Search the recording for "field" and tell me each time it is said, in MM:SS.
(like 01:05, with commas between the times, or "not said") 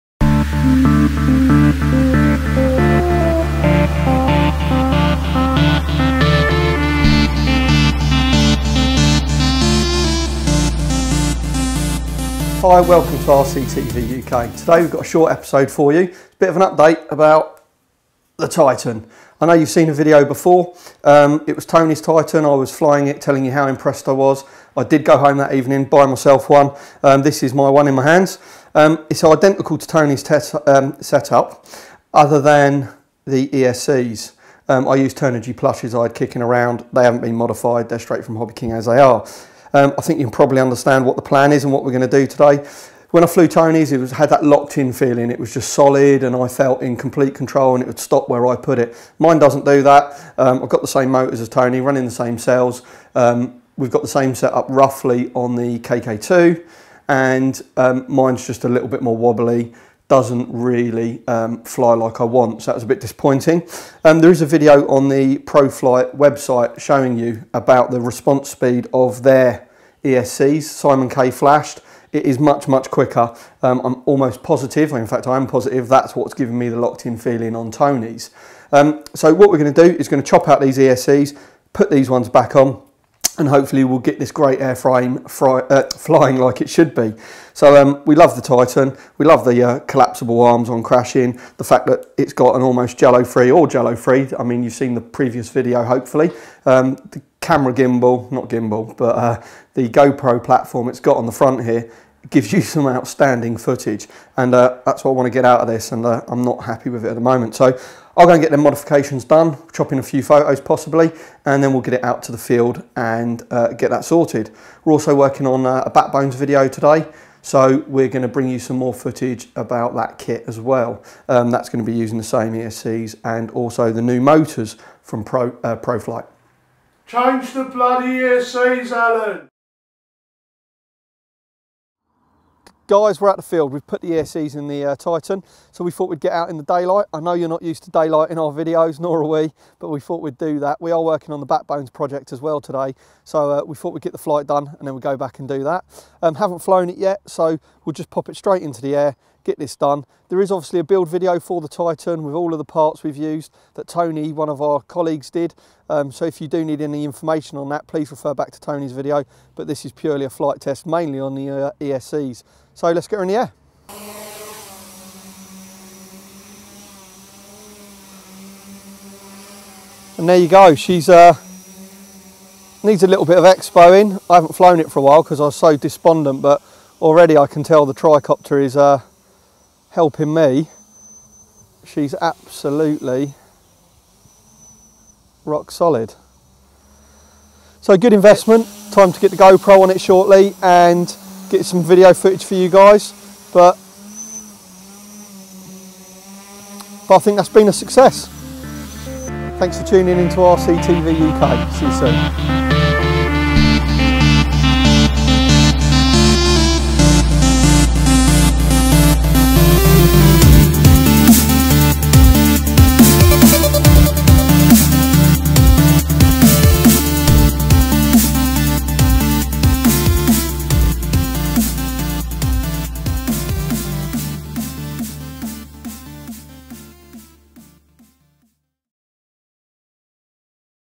01:52, 02:13.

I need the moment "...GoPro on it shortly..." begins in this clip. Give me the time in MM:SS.
03:09.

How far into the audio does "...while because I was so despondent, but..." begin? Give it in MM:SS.
02:55.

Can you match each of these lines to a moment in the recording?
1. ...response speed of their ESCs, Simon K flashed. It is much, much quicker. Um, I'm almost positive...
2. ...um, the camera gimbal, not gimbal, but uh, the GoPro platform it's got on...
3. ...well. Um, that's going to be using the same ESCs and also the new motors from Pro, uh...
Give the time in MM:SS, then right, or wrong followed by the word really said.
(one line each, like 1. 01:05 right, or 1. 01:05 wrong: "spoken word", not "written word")
1. 01:08 right
2. 01:36 right
3. 02:00 right.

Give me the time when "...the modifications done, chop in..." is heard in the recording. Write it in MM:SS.
01:48.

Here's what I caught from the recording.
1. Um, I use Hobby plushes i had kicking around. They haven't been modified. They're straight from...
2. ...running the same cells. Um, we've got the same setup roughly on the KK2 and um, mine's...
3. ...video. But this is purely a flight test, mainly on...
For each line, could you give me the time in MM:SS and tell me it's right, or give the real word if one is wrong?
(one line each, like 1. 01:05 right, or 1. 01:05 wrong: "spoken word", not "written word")
1. 00:34 wrong: "Turnigy", not "Hobby"
2. 00:51 right
3. 02:38 right.